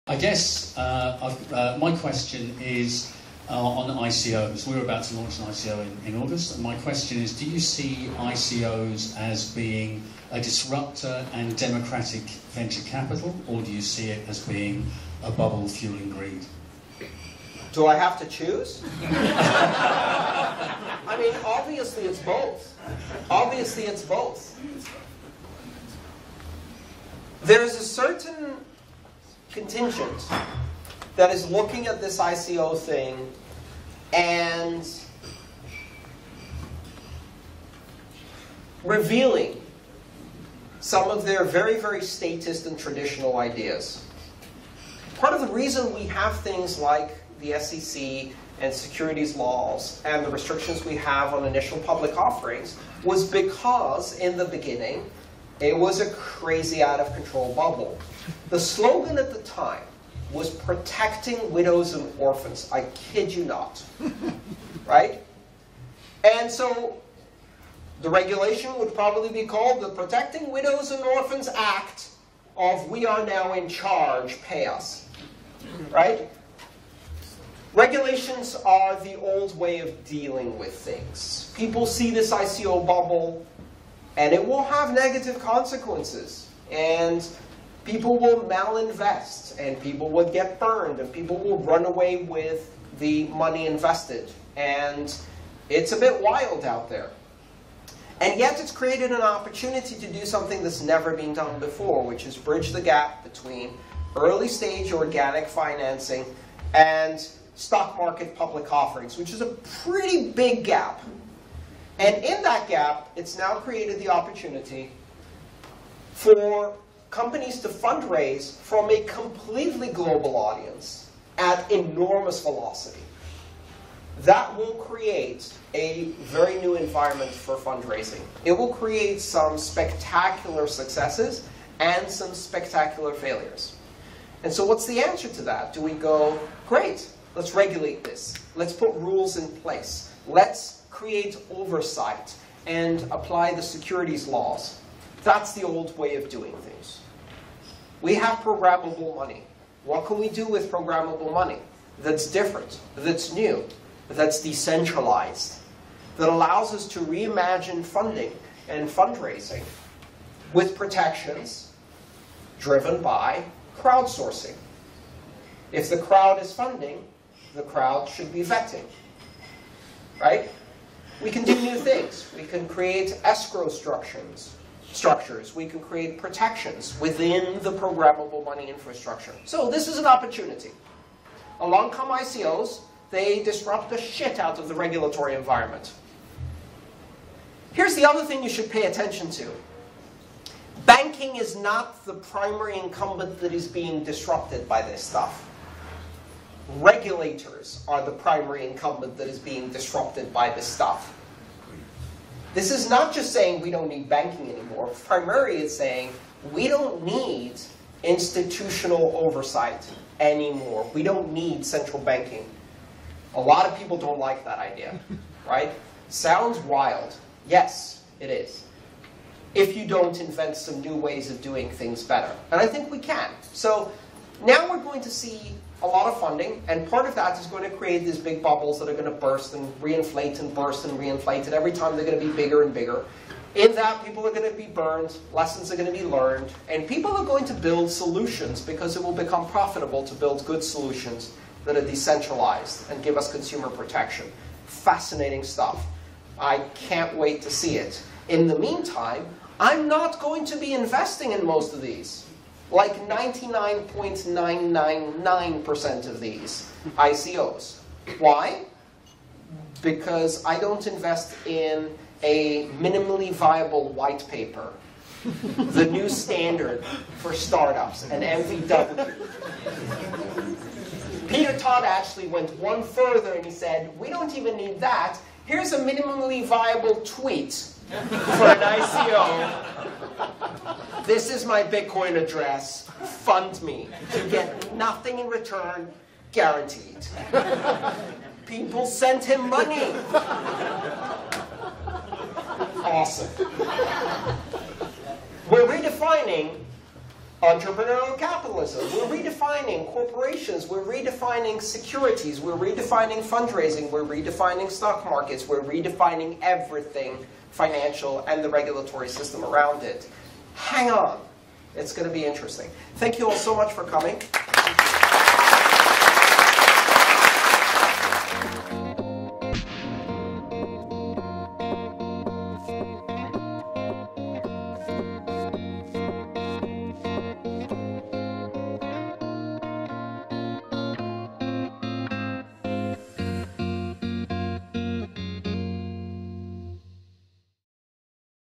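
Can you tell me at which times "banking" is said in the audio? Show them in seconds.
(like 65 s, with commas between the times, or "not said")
190 s, 204 s, 212 s.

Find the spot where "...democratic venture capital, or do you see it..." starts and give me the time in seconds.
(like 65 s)
11 s.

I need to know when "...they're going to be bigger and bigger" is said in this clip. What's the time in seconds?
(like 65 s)
231 s.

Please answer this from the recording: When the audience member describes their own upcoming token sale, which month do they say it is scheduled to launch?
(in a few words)
August.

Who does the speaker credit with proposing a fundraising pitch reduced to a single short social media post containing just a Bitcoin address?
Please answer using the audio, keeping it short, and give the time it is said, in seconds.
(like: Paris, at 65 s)
Peter Todd, at 271 s.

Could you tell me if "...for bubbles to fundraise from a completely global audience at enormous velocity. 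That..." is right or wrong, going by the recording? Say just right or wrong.
wrong.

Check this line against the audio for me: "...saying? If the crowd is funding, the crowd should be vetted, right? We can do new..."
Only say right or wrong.
wrong.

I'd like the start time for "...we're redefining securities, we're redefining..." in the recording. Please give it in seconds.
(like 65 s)
300 s.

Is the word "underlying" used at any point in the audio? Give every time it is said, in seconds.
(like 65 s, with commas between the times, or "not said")
not said.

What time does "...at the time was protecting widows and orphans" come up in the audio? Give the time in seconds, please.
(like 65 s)
59 s.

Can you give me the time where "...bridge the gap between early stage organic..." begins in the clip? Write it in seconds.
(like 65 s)
102 s.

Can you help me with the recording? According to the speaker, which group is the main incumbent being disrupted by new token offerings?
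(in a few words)
Regulators.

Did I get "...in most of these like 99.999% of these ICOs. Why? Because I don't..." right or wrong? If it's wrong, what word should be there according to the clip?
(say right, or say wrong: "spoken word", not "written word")
right.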